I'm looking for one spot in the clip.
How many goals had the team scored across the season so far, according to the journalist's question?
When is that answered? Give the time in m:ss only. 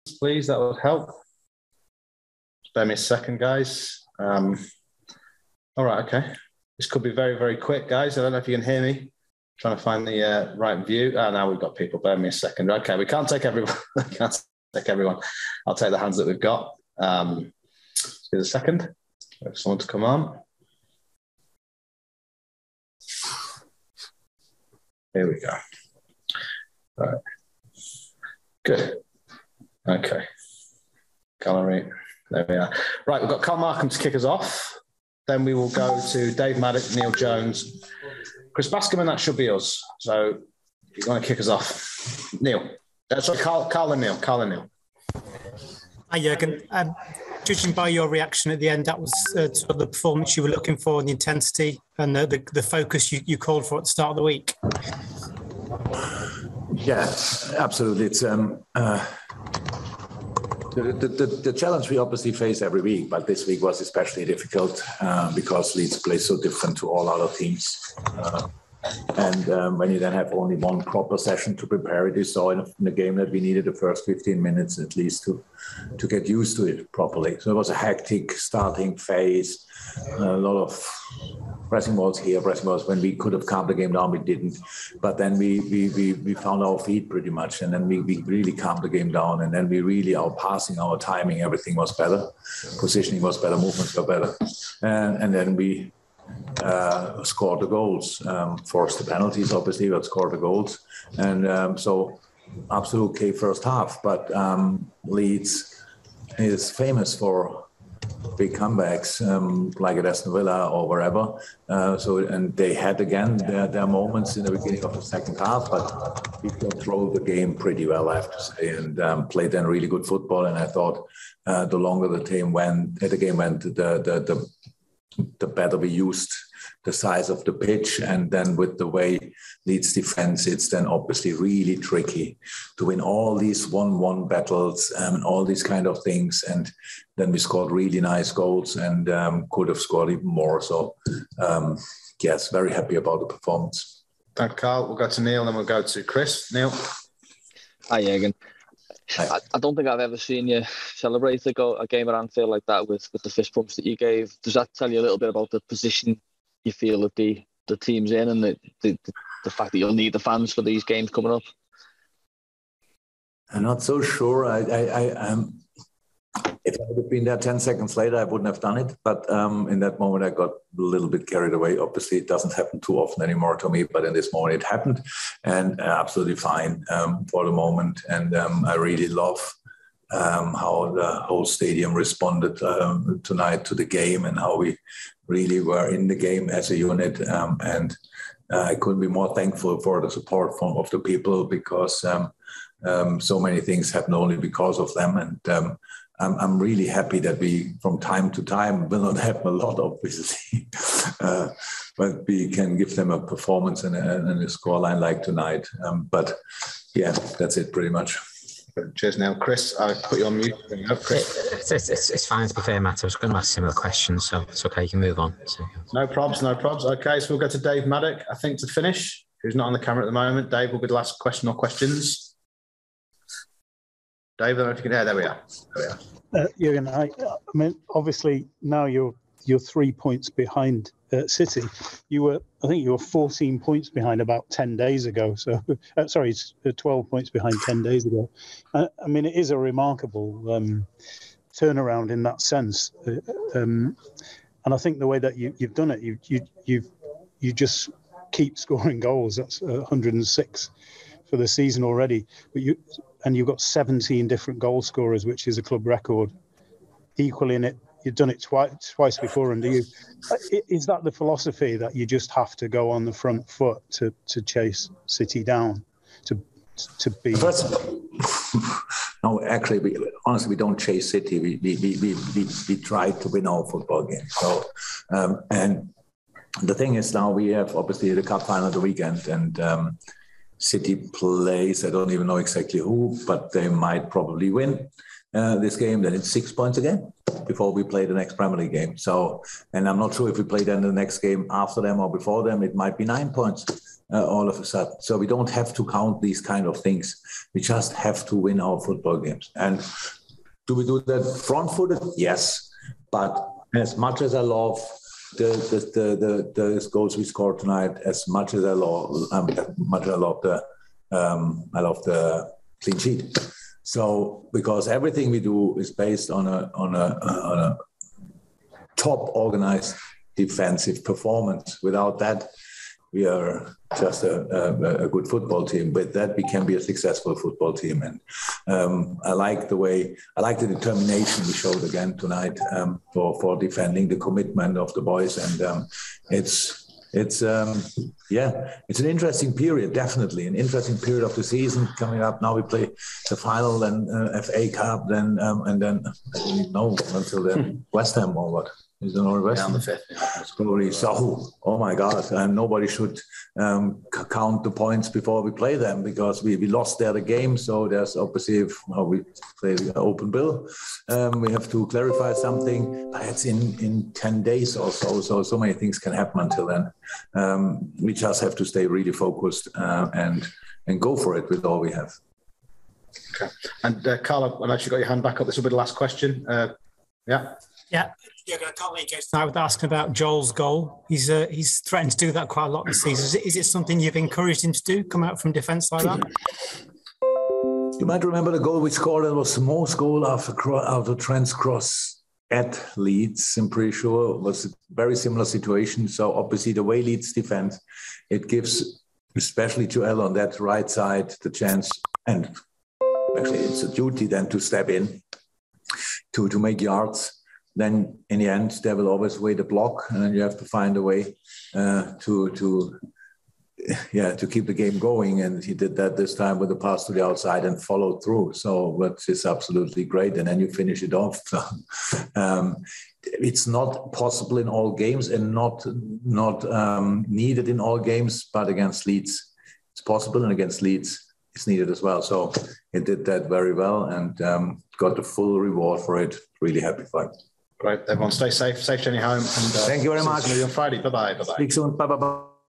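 4:09.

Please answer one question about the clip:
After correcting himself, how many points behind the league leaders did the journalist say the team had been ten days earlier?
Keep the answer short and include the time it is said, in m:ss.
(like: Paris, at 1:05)
12, at 3:56.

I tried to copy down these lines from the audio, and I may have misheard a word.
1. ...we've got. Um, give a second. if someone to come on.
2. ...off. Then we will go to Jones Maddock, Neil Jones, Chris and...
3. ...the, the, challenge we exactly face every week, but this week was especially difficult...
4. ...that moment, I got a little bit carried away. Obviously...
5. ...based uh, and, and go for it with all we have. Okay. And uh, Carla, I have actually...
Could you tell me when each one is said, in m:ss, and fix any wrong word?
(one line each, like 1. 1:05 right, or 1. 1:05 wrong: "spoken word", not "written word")
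1. 0:16 right
2. 0:34 wrong: "Dave", not "Jones"
3. 1:01 wrong: "obviously", not "exactly"
4. 2:49 right
5. 6:09 wrong: "focused", not "based".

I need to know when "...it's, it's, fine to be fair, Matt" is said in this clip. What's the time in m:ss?
3:31.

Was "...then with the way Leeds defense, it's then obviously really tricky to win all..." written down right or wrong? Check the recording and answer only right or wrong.
right.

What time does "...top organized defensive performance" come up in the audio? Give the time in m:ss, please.
5:18.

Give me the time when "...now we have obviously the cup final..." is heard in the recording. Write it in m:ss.
4:37.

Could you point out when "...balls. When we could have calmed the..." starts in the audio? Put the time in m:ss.
1:22.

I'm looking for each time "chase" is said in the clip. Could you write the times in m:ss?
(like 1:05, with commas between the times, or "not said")
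4:24, 4:30.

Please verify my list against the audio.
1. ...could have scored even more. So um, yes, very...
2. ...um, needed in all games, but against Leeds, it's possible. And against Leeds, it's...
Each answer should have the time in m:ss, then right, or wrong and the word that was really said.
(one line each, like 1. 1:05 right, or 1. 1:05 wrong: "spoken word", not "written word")
1. 2:19 right
2. 7:06 right.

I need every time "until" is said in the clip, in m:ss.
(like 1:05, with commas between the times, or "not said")
5:47, 6:06.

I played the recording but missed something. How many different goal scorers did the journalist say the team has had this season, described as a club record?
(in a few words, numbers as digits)
17.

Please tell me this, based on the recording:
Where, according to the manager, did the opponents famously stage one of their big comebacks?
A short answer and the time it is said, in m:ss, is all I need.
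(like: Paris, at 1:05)
Aston Villa, at 1:50.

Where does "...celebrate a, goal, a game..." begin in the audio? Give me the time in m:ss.
2:30.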